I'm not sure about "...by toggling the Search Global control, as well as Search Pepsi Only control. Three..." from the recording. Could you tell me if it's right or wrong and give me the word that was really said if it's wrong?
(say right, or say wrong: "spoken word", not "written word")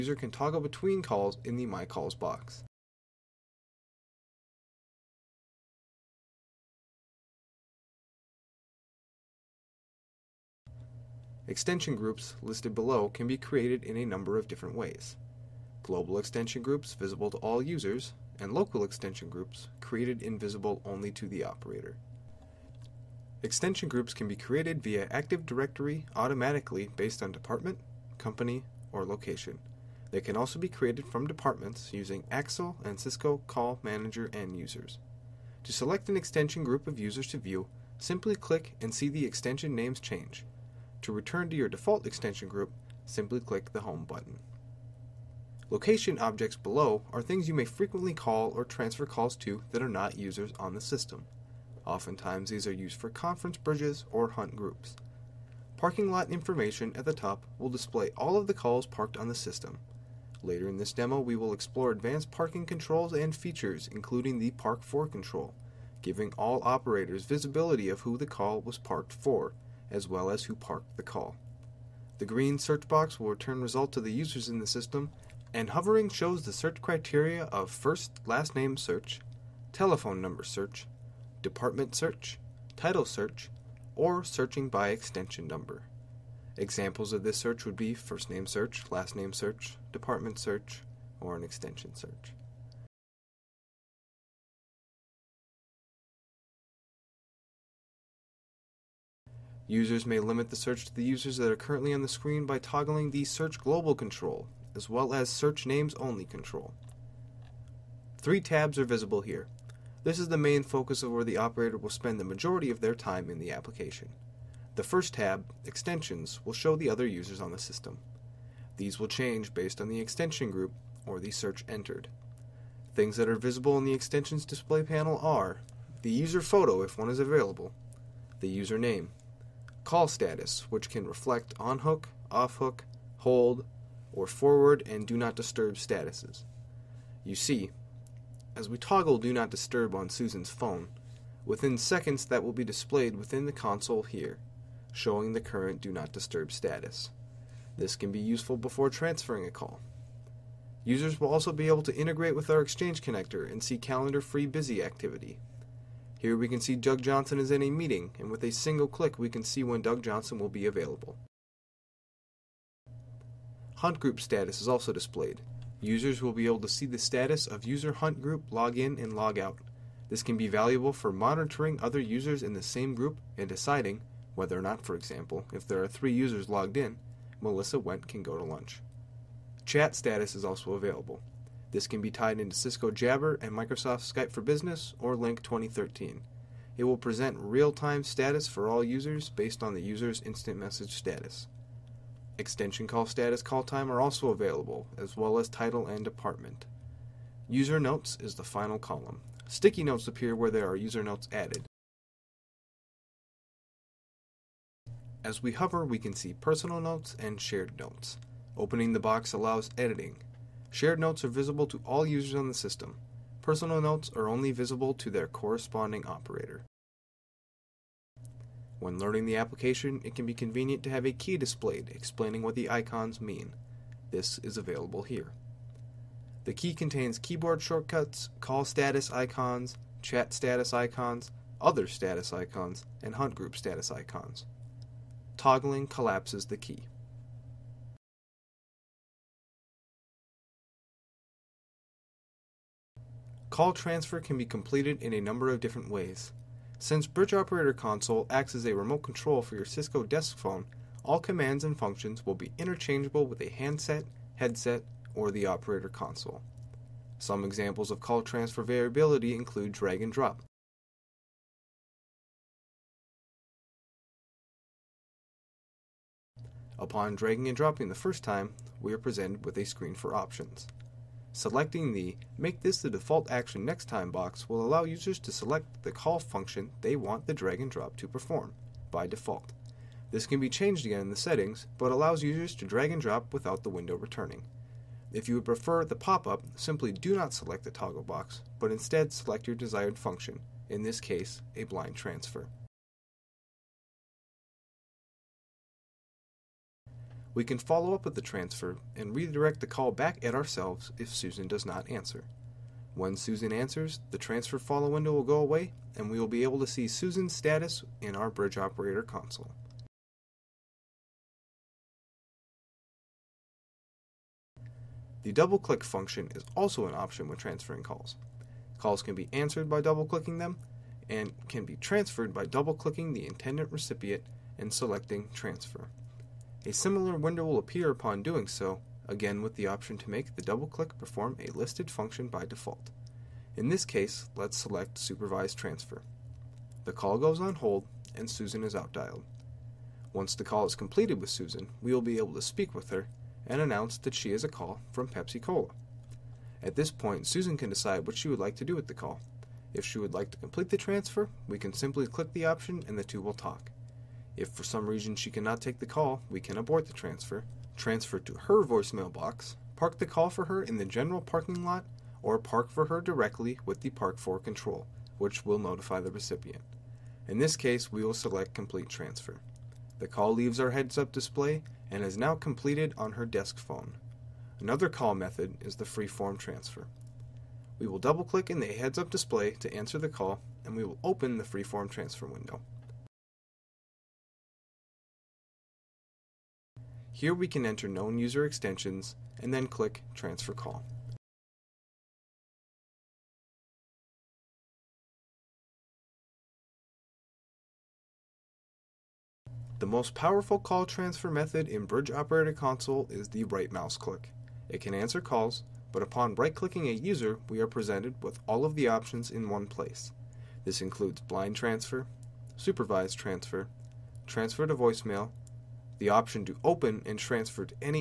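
wrong: "Names", not "Pepsi".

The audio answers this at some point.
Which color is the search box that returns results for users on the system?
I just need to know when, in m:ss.
1:12.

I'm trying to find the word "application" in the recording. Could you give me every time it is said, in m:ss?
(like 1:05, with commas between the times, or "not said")
1:53, 3:39.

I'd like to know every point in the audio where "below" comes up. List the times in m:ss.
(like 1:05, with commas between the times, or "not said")
0:12, 0:46.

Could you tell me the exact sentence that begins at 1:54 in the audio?
The first tab, Extensions, will show the other users on the system.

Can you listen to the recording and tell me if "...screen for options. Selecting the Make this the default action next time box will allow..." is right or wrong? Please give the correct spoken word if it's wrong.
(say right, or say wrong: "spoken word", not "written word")
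right.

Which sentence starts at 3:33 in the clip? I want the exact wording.
Personal notes are only visible to their corresponding operator.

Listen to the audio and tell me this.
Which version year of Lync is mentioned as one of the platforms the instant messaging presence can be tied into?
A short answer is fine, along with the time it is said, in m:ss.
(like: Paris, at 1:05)
2013, at 3:05.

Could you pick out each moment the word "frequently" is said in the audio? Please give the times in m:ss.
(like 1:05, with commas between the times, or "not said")
0:47.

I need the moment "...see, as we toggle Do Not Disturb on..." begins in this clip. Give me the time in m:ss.
2:17.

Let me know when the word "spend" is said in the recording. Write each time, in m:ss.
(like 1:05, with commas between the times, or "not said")
1:51.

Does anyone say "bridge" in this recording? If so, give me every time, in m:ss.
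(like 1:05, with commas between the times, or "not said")
0:53, 4:07, 5:08, 6:41.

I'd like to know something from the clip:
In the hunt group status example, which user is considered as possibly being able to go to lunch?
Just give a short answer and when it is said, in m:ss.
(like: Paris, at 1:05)
Melissa Went, at 2:57.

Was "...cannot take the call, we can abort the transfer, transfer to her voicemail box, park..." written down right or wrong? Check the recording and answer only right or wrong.
right.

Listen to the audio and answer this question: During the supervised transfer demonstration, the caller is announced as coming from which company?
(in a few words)
Pepsi Cola.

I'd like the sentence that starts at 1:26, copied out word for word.
Examples of this search would be first name search, last name search, department search, or an extension search.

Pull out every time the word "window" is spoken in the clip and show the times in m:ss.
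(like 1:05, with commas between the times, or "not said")
4:43, 5:04, 5:27, 6:22.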